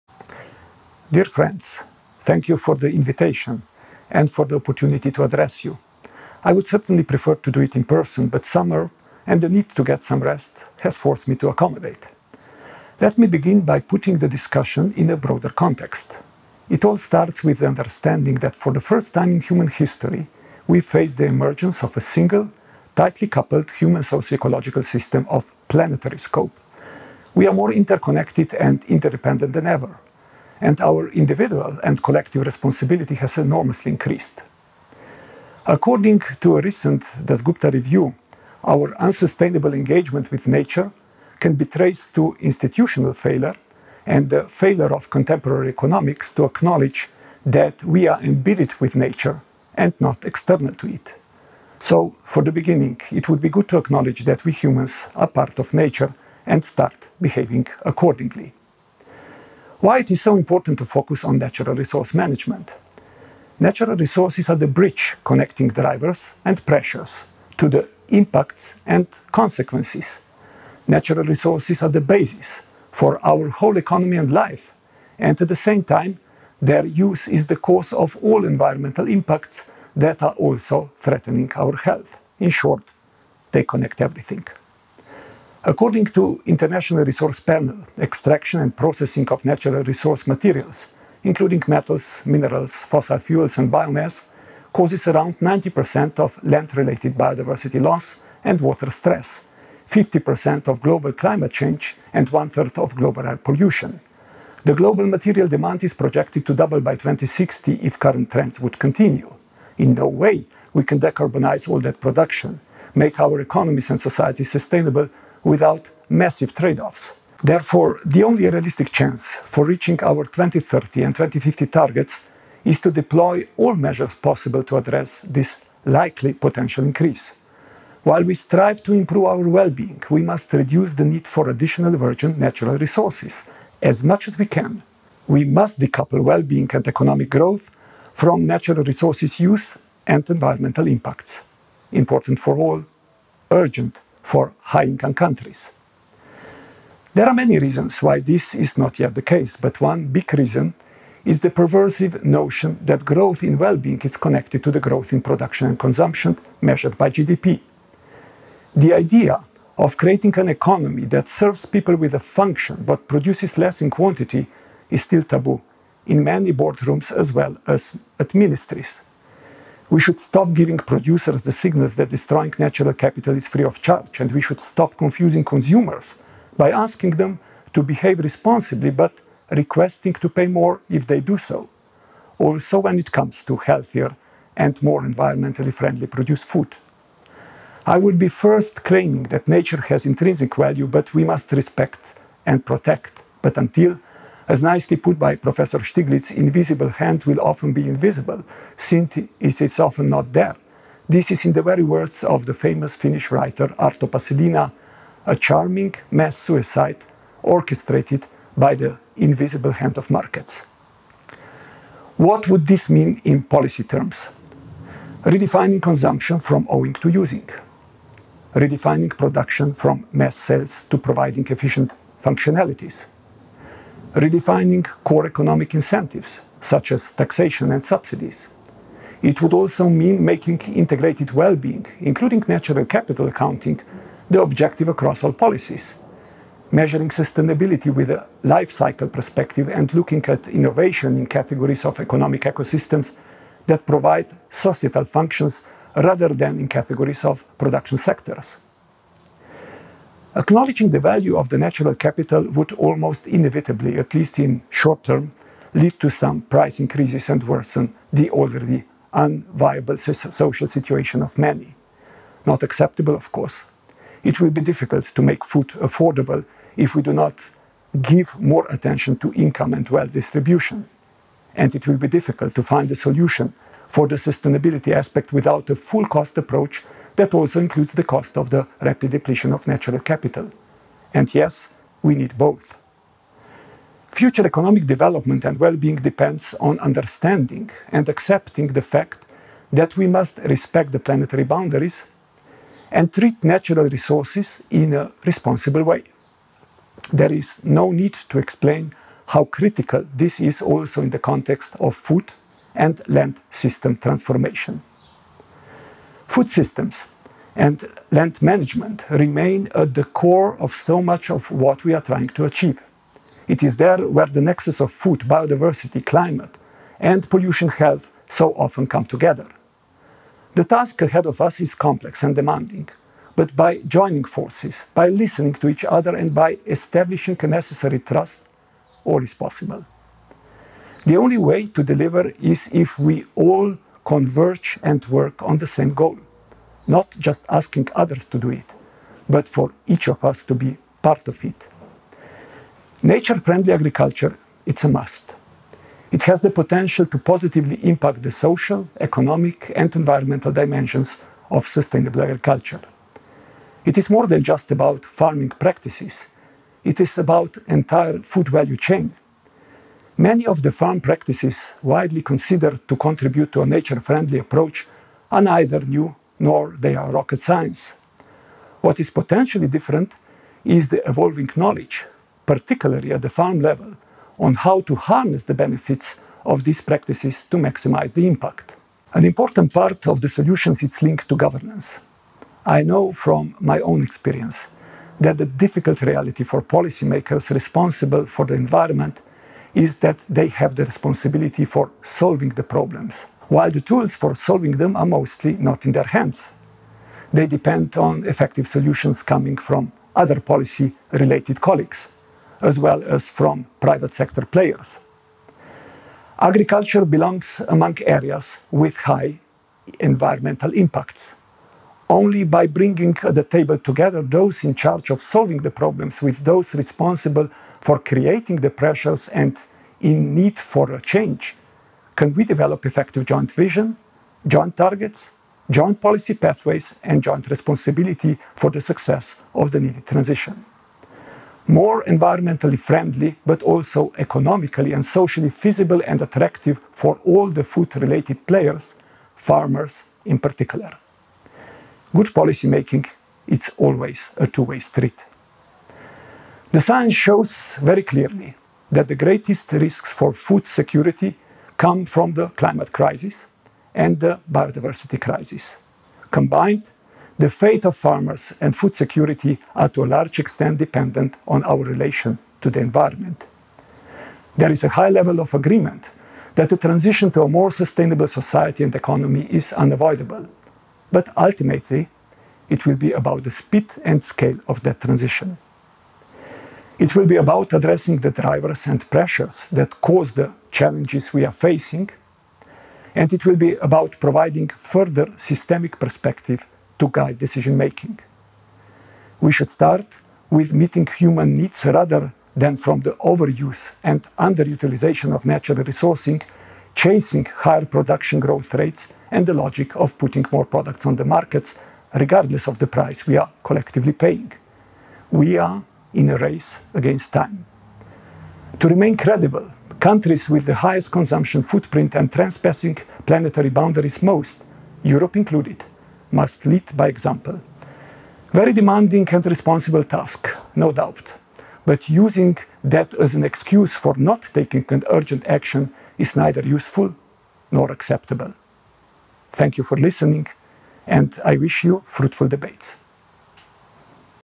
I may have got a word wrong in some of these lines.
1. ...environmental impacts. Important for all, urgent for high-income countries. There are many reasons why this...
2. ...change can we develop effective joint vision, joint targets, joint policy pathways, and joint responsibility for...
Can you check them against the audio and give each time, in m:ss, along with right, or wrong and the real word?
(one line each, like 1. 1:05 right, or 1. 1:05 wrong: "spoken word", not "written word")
1. 2:20 right
2. 7:01 right.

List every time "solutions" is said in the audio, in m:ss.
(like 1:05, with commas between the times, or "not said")
4:32, 6:20, 6:38.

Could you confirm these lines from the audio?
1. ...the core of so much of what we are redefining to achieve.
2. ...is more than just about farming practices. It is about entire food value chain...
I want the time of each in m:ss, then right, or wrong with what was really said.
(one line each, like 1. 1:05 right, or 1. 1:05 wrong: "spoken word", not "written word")
1. 5:09 wrong: "trying", not "redefining"
2. 5:53 right.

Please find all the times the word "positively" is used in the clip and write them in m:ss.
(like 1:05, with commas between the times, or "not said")
5:47.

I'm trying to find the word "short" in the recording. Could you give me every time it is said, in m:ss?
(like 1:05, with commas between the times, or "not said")
1:22, 4:14.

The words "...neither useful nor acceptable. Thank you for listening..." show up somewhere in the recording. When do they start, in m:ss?
8:46.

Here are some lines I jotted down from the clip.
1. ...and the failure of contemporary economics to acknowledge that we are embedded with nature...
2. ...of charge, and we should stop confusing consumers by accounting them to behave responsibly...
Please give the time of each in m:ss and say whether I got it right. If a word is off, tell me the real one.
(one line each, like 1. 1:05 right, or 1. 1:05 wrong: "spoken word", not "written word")
1. 0:44 right
2. 2:53 wrong: "asking", not "accounting".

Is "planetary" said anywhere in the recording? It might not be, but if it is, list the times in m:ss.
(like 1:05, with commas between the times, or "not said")
0:25, 4:50, 8:33.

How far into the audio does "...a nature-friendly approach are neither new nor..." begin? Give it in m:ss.
6:03.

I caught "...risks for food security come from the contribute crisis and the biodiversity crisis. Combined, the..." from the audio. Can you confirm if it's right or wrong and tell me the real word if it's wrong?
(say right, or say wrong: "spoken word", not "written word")
wrong: "climate", not "contribute".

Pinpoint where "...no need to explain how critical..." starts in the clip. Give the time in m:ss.
4:57.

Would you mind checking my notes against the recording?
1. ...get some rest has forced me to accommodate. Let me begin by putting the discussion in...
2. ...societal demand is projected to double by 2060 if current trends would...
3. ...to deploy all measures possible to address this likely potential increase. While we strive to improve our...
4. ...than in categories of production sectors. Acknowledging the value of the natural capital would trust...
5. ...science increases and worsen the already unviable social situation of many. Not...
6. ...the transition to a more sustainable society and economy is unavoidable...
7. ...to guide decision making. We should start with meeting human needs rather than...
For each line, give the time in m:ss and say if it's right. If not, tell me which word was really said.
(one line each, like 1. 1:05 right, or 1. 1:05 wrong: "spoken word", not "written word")
1. 0:09 right
2. 1:45 wrong: "material", not "societal"
3. 2:02 right
4. 4:06 wrong: "almost", not "trust"
5. 4:16 wrong: "price", not "science"
6. 7:46 right
7. 8:06 right.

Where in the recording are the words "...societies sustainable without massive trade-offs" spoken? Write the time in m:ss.
1:54.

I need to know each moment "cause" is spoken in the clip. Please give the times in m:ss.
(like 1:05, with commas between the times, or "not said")
1:17, 1:34, 8:00.